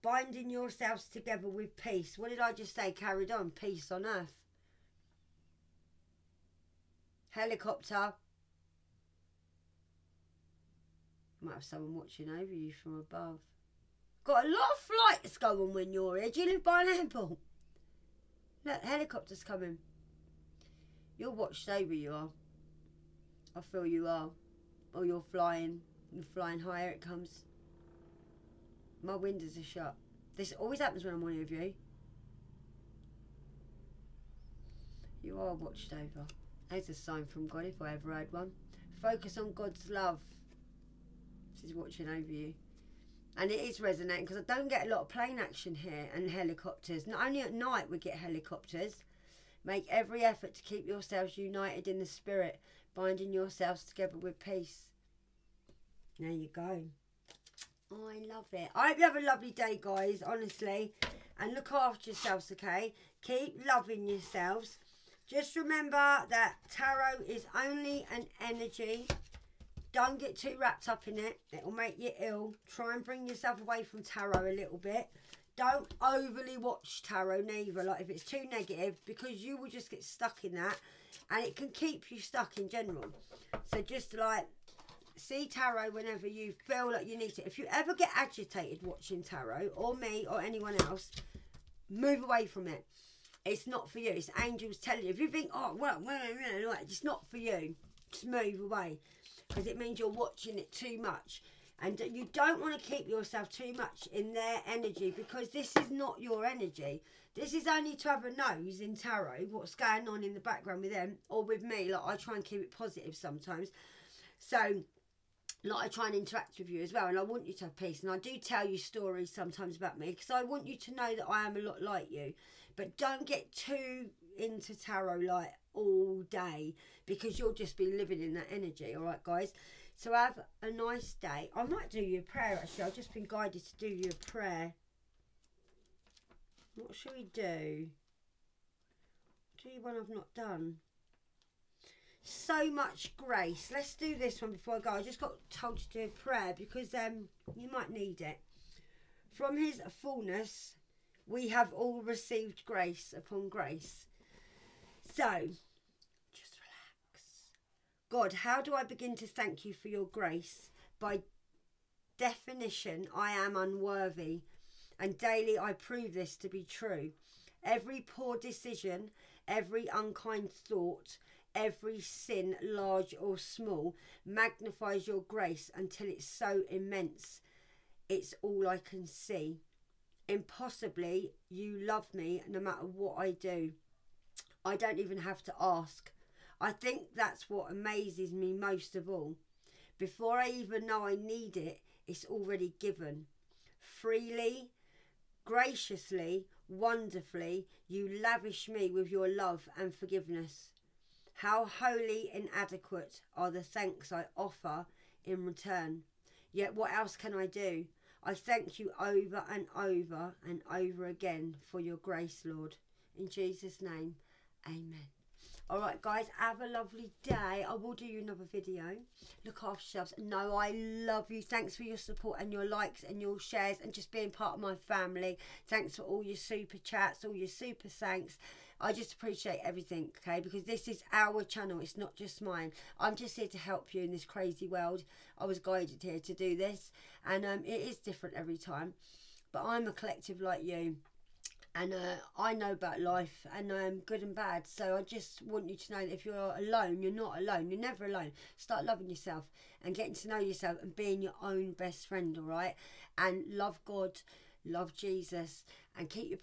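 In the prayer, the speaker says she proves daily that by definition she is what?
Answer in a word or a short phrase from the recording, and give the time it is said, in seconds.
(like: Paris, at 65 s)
Unworthy, at 163 s.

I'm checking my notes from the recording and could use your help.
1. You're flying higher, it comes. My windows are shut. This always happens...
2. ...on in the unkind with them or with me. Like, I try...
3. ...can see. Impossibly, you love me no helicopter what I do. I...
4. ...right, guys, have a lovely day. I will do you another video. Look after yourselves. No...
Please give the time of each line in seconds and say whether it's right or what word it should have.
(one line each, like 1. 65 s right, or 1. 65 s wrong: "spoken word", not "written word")
1. 26 s right
2. 110 s wrong: "background", not "unkind"
3. 178 s wrong: "matter", not "helicopter"
4. 215 s right.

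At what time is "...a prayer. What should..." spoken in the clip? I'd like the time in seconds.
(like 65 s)
134 s.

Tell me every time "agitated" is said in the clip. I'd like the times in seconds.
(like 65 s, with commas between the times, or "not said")
88 s.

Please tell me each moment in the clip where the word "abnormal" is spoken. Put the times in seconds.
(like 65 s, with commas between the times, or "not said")
not said.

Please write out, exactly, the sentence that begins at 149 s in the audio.
From his fullness we have all received grace upon grace.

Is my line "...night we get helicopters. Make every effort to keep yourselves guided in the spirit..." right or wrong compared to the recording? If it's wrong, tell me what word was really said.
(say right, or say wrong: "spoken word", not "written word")
wrong: "united", not "guided".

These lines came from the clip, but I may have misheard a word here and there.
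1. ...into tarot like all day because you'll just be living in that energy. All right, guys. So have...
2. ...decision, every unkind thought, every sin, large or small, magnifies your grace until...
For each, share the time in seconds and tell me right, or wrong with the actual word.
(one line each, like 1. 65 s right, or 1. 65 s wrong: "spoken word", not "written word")
1. 124 s right
2. 168 s right.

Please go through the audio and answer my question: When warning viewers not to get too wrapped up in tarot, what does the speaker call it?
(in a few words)
Only an energy.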